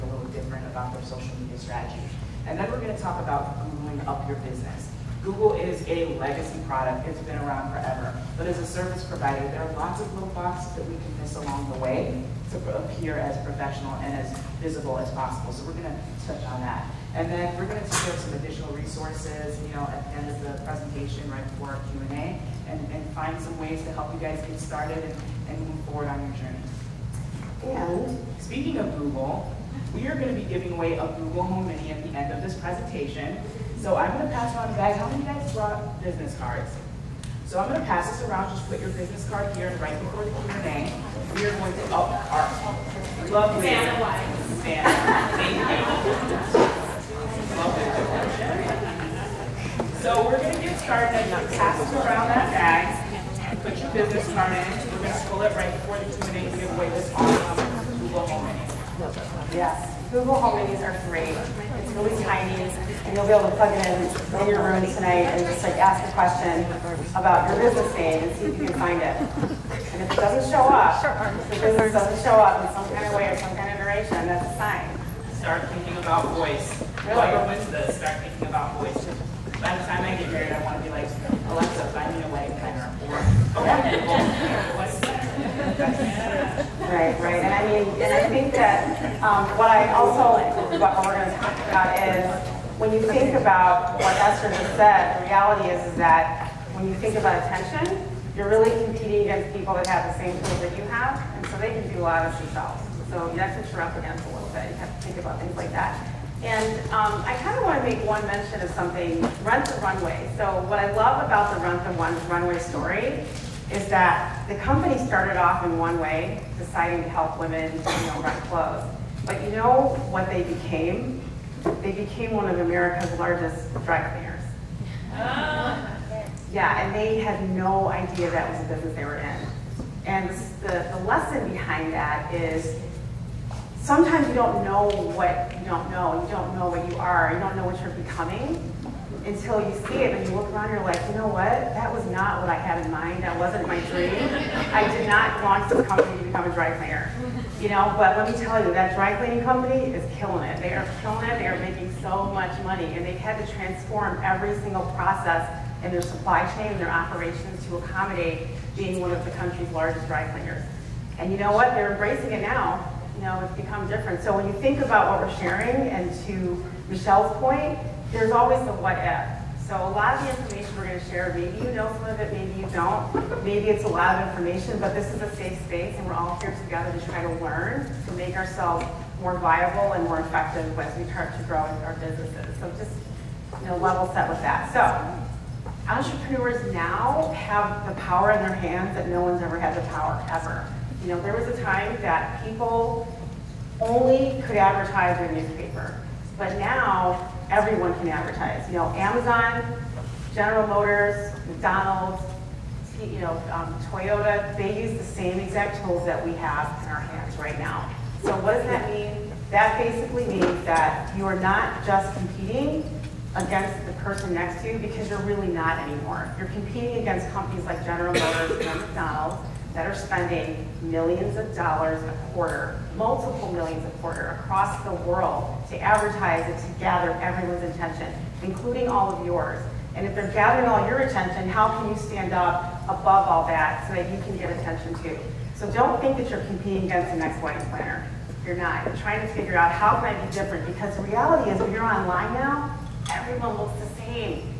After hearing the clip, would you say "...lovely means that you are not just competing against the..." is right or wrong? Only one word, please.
wrong.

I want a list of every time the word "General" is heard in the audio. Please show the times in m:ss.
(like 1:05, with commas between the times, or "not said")
3:20, 3:37.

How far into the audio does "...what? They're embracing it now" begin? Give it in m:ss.
2:41.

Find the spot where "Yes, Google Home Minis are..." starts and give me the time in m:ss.
0:59.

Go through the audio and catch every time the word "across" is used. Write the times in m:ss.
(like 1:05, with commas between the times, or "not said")
3:44.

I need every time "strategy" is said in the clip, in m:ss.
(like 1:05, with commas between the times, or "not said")
0:01.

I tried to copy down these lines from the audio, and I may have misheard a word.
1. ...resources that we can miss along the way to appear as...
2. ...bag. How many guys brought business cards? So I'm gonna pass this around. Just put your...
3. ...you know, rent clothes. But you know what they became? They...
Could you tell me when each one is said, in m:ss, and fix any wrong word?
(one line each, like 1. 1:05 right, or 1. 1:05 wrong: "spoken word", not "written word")
1. 0:10 wrong: "boxes", not "resources"
2. 0:34 right
3. 1:57 right.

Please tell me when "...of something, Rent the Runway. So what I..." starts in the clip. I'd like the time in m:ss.
1:48.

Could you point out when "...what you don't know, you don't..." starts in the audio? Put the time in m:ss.
2:15.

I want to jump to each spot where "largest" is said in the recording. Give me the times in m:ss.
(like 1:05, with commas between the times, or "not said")
2:03, 2:39.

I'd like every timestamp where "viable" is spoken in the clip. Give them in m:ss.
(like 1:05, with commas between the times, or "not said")
2:59.